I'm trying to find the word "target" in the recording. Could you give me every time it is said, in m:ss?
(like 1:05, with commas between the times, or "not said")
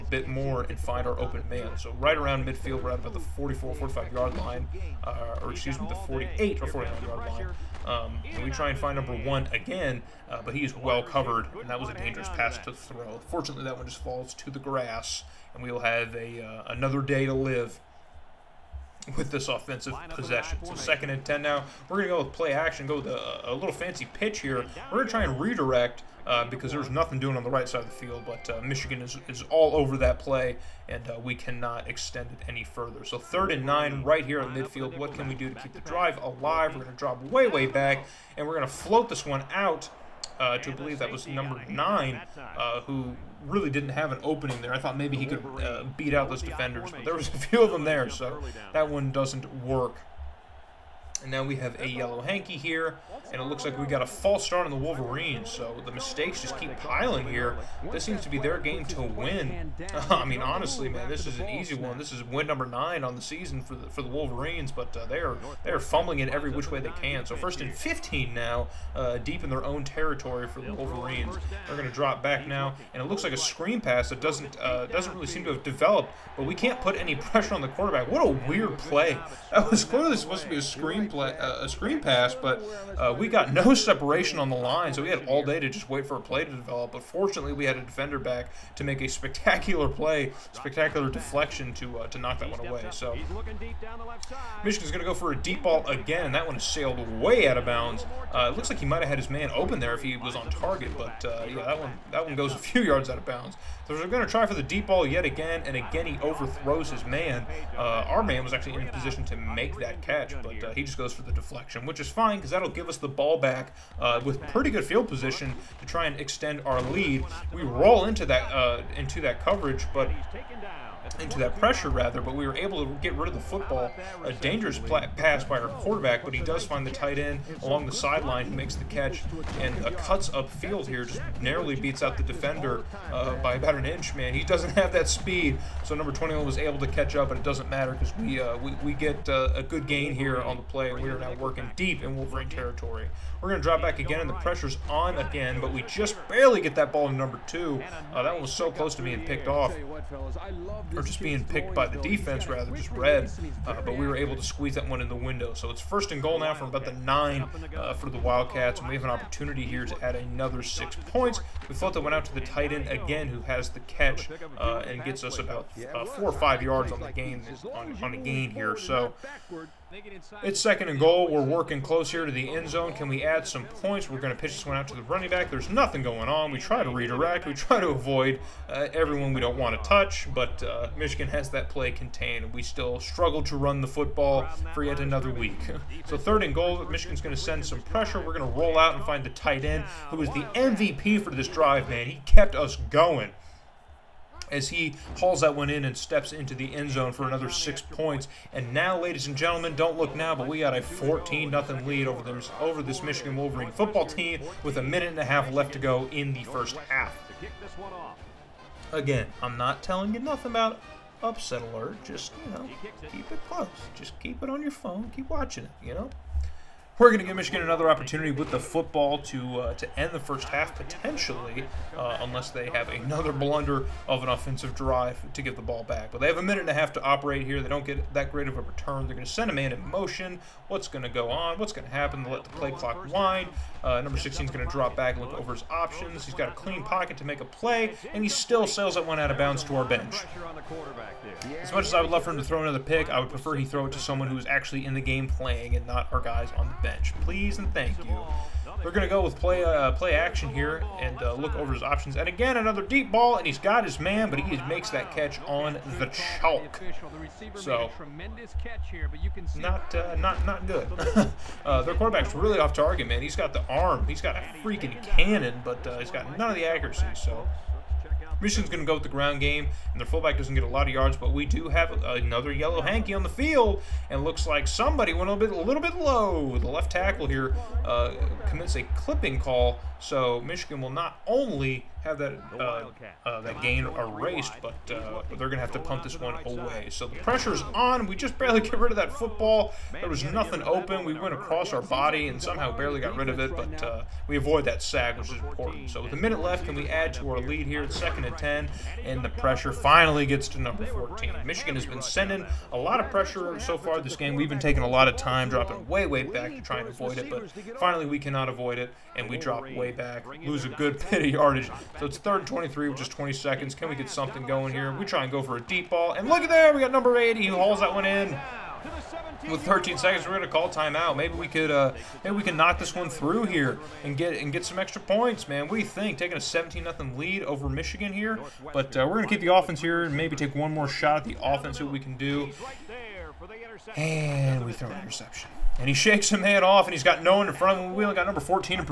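1:40, 4:22.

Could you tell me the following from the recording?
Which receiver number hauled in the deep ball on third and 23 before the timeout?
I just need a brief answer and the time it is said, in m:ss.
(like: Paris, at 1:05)
80, at 5:16.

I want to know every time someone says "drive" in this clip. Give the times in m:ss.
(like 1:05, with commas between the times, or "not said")
0:35, 3:11, 3:44.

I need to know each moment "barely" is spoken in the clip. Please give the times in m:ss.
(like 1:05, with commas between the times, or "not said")
2:26, 4:48, 4:52.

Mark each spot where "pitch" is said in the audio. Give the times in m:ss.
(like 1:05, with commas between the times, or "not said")
0:24, 2:54.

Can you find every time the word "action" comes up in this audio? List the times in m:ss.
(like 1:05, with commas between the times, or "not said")
0:22, 4:10.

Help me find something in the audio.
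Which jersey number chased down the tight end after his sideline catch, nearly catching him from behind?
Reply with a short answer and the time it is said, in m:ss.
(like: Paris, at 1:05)
21, at 2:15.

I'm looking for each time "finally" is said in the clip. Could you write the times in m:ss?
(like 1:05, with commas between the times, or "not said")
4:59, 5:07.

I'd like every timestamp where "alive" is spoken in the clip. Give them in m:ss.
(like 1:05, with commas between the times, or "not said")
0:36.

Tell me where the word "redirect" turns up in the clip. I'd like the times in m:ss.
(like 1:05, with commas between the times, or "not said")
0:25, 2:56.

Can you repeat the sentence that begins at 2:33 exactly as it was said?
Uh, but we were able to squeeze that one in the window.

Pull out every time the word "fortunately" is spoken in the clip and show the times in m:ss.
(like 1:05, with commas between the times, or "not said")
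0:13, 1:27.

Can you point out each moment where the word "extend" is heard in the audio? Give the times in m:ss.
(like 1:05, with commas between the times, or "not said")
0:31, 1:56.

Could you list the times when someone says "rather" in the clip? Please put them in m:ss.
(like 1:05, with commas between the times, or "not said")
2:01, 2:32.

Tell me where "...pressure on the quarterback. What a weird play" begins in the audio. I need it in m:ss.
1:17.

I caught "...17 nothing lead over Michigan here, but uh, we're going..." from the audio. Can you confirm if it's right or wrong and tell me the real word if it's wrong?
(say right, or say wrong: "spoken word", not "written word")
right.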